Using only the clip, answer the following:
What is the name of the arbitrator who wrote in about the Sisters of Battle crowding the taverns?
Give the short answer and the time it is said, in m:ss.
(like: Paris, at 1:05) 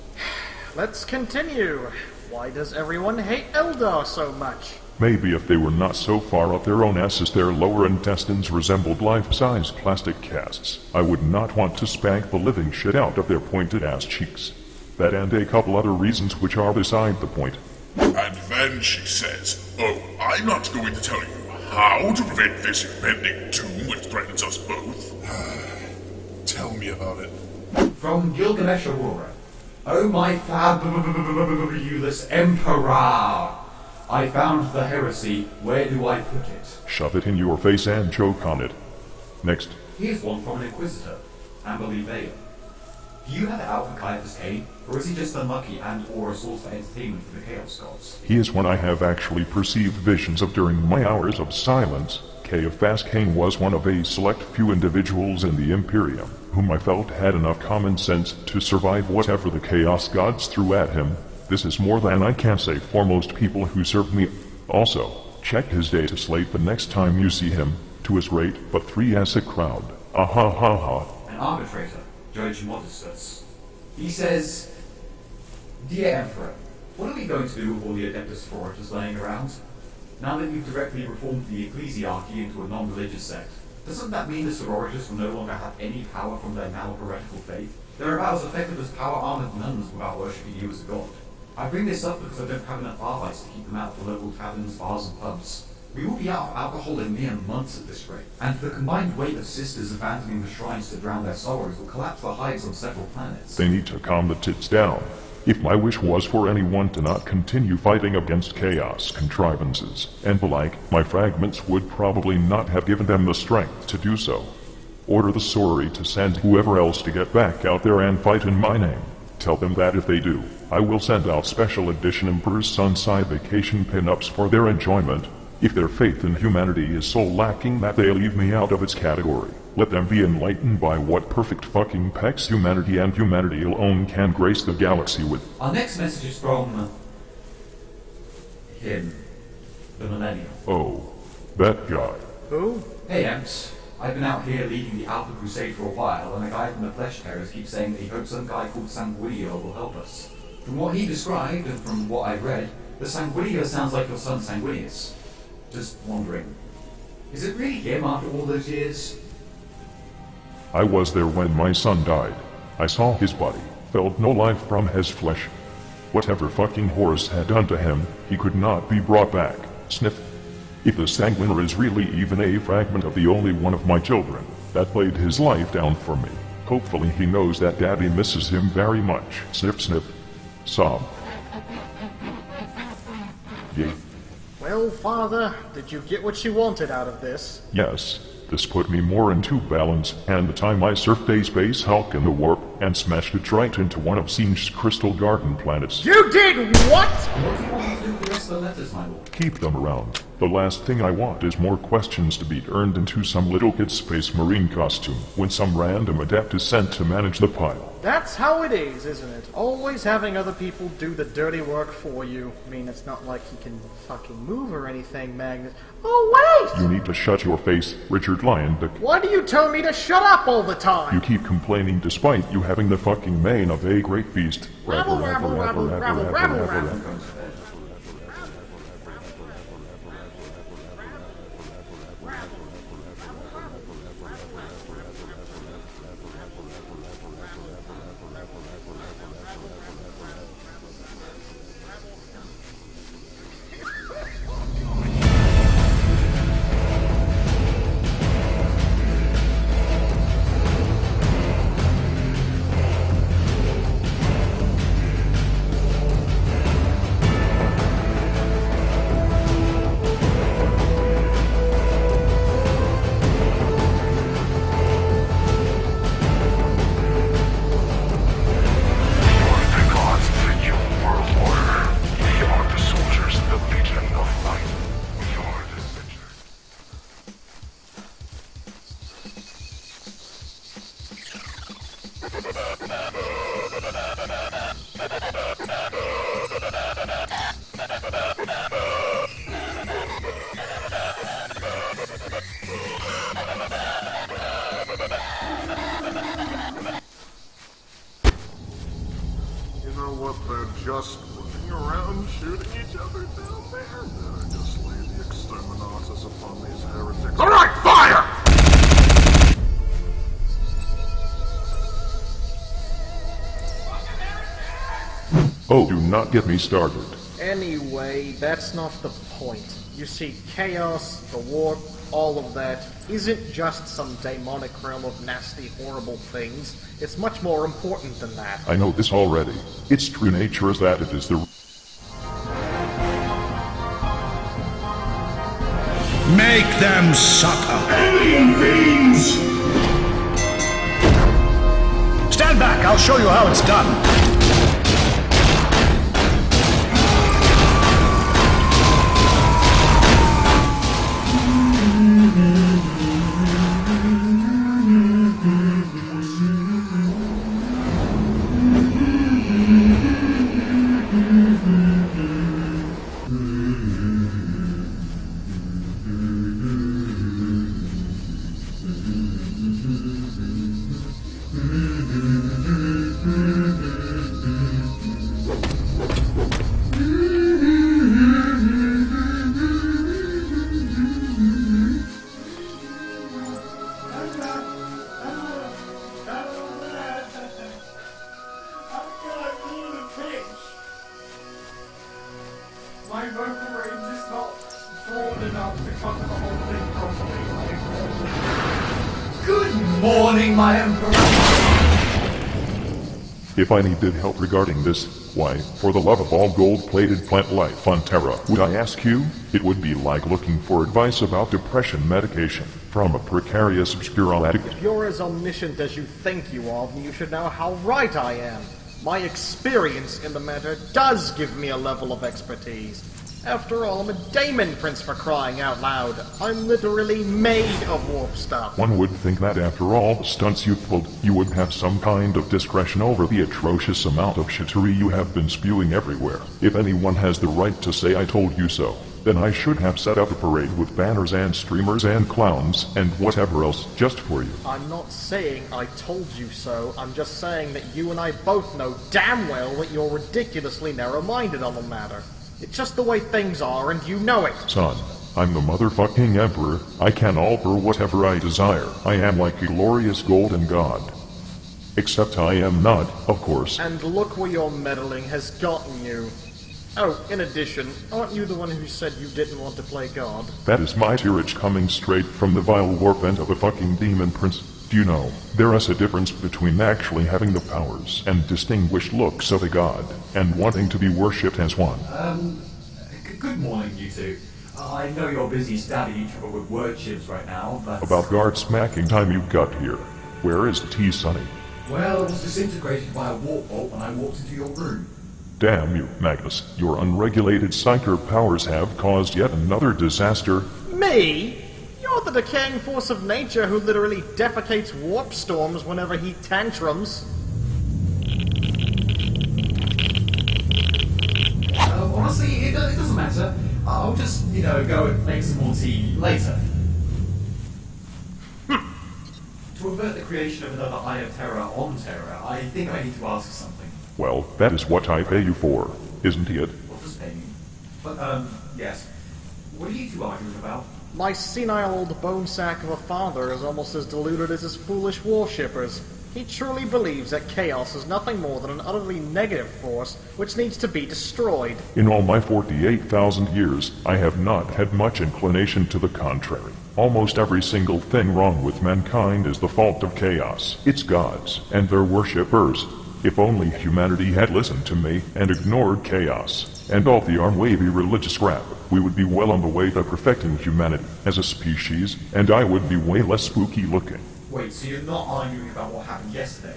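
Judge Modestus, at 1:12.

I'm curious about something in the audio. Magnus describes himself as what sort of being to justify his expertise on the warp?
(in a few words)
Daemon Prince.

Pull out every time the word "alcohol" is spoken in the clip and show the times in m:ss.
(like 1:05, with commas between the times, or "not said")
1:36.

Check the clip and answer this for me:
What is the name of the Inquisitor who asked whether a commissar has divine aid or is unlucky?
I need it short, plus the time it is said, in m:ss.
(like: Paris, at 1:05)
Amberly Vail, at 0:41.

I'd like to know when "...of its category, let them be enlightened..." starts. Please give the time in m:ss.
2:08.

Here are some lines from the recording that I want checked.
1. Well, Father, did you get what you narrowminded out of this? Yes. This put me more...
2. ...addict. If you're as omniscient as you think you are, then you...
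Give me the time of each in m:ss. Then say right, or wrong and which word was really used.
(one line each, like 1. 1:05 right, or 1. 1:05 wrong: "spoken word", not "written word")
1. 3:04 wrong: "wanted", not "narrowminded"
2. 6:54 right.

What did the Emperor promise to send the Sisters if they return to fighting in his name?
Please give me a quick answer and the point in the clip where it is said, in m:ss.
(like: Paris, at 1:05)
Sunside vacation pinups, at 2:02.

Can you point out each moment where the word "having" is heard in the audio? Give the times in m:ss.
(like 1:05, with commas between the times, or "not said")
3:30, 3:42, 7:57.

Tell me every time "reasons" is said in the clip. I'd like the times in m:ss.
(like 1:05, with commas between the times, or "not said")
0:15.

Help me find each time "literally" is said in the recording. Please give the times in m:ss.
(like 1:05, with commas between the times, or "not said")
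7:06, 8:23.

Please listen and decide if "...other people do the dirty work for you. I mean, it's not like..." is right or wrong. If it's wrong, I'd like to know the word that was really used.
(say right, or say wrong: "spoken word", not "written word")
right.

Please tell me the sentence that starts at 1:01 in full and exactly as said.
This is more than I can say for most people who served me.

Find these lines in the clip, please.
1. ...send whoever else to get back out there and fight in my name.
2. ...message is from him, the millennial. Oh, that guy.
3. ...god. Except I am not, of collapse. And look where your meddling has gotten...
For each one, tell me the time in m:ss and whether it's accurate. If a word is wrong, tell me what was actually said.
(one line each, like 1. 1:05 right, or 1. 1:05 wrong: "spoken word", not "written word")
1. 1:56 right
2. 2:15 right
3. 7:40 wrong: "course", not "collapse".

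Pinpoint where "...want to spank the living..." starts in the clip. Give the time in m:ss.
0:11.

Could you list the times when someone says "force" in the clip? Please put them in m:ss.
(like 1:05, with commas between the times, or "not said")
8:22, 8:59.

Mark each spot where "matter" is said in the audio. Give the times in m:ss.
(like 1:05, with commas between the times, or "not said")
7:00, 7:31, 8:33.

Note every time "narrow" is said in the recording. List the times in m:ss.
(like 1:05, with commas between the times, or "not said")
7:30.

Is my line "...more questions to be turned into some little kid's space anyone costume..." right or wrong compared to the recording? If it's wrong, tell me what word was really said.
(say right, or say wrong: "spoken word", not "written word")
wrong: "marine", not "anyone".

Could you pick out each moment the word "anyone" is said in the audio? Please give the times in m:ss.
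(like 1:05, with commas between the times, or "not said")
1:46, 7:16.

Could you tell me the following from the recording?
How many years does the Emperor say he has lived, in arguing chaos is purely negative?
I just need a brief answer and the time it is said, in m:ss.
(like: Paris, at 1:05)
48,000, at 9:02.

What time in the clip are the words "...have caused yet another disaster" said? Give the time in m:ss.
8:18.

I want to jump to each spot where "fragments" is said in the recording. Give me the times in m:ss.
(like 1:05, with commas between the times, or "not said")
1:51, 2:52.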